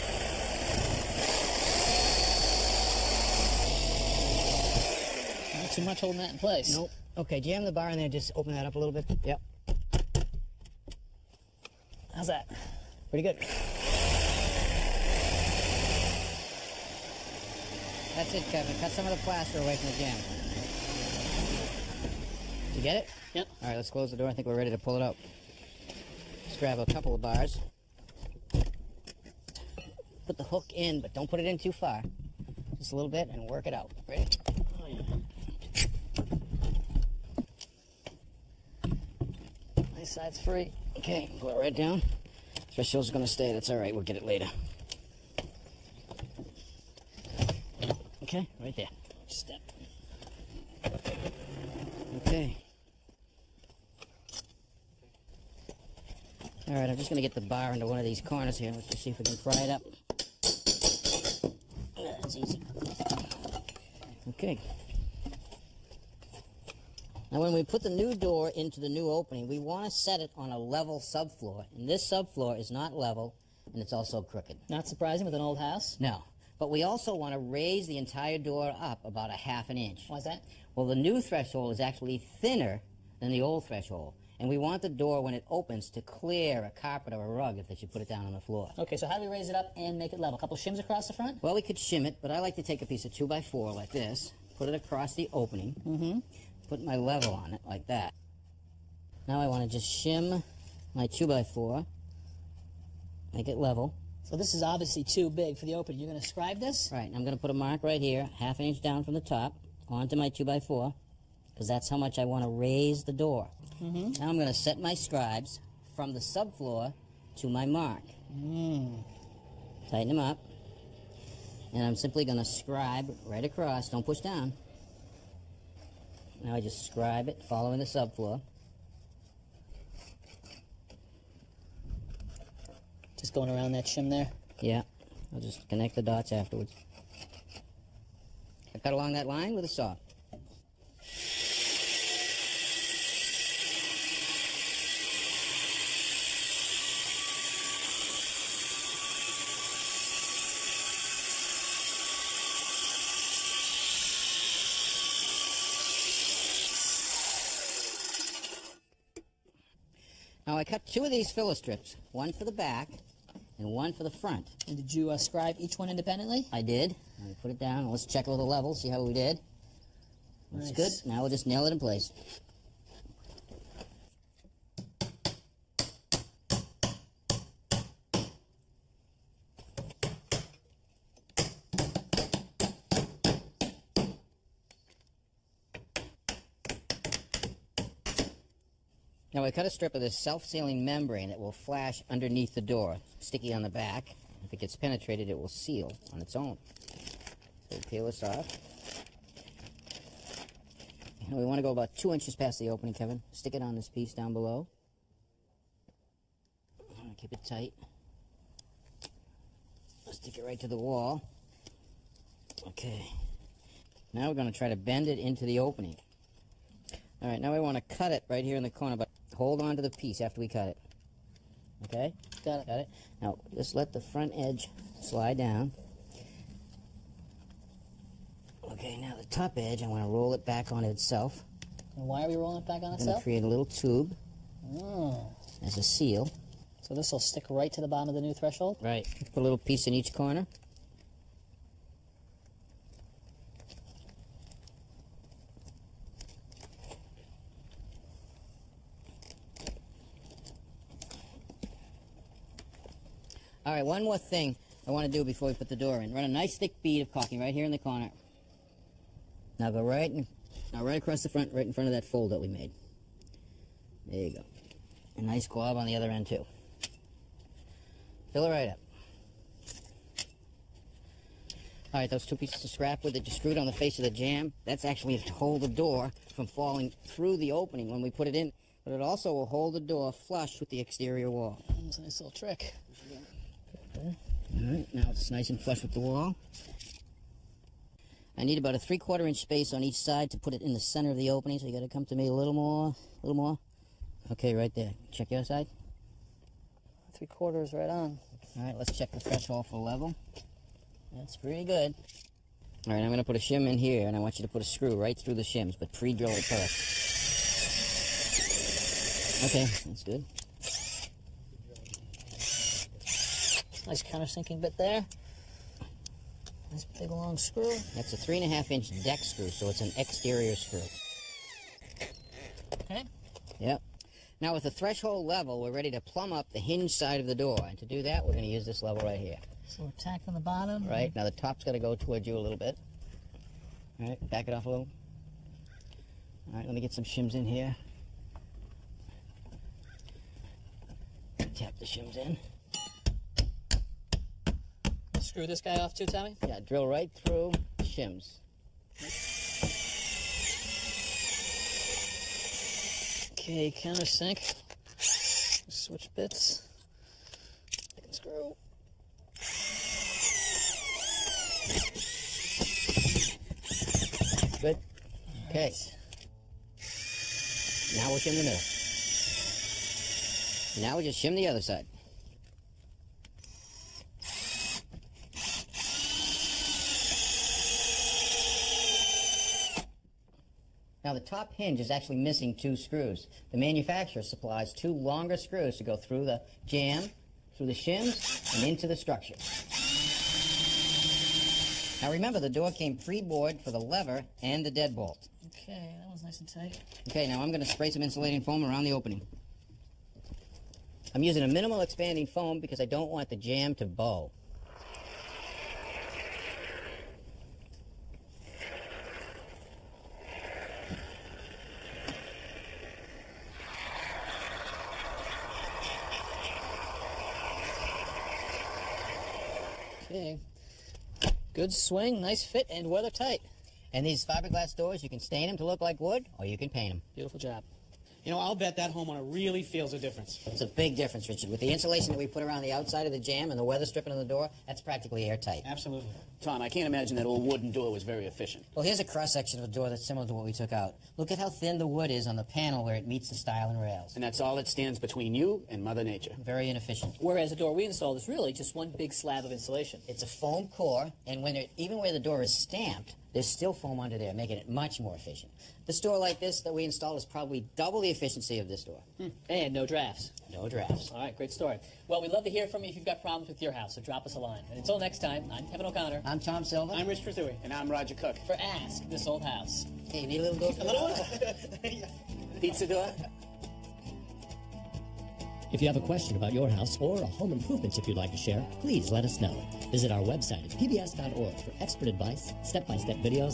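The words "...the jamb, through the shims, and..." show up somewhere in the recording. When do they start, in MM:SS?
06:26.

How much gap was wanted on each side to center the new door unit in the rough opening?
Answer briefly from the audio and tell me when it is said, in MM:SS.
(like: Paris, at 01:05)
3/4 inch, at 04:48.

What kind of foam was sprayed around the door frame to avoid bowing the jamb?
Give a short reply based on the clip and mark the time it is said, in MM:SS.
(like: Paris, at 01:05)
minimal expanding foam, at 06:41.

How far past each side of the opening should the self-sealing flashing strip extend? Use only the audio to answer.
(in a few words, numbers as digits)
2 inches.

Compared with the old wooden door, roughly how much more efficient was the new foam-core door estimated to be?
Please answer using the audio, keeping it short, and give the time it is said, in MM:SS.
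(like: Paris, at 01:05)
double, at 07:37.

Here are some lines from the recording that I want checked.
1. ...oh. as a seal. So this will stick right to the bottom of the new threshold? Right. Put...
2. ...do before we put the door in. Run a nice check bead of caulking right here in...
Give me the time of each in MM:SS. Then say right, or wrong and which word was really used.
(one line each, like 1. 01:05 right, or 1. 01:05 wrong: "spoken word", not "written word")
1. 03:54 right
2. 04:15 wrong: "thick", not "check".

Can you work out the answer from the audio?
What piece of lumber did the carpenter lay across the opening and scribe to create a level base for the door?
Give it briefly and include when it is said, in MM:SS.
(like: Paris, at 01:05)
2 by 4, at 01:32.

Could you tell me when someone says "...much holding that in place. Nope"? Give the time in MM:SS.
00:05.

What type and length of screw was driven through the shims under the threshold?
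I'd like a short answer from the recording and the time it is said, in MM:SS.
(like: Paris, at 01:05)
3.5 inch deck screw, at 05:18.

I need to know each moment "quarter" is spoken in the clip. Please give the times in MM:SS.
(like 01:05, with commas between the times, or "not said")
04:48, 04:57.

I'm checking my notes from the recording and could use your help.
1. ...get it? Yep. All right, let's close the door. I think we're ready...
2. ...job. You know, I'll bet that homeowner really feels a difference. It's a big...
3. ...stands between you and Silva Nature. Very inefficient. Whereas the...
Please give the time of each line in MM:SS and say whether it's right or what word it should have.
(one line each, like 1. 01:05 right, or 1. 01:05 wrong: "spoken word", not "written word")
1. 00:22 right
2. 07:07 right
3. 07:24 wrong: "Mother", not "Silva".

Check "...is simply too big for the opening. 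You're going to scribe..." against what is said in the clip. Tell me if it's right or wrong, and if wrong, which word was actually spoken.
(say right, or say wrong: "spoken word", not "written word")
wrong: "obviously", not "simply".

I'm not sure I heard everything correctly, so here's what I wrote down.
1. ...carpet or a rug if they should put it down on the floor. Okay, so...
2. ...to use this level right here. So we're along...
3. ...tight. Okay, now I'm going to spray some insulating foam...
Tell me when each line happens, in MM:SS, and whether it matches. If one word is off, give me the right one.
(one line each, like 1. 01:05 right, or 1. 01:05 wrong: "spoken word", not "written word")
1. 01:26 right
2. 05:28 wrong: "tacking", not "along"
3. 06:36 right.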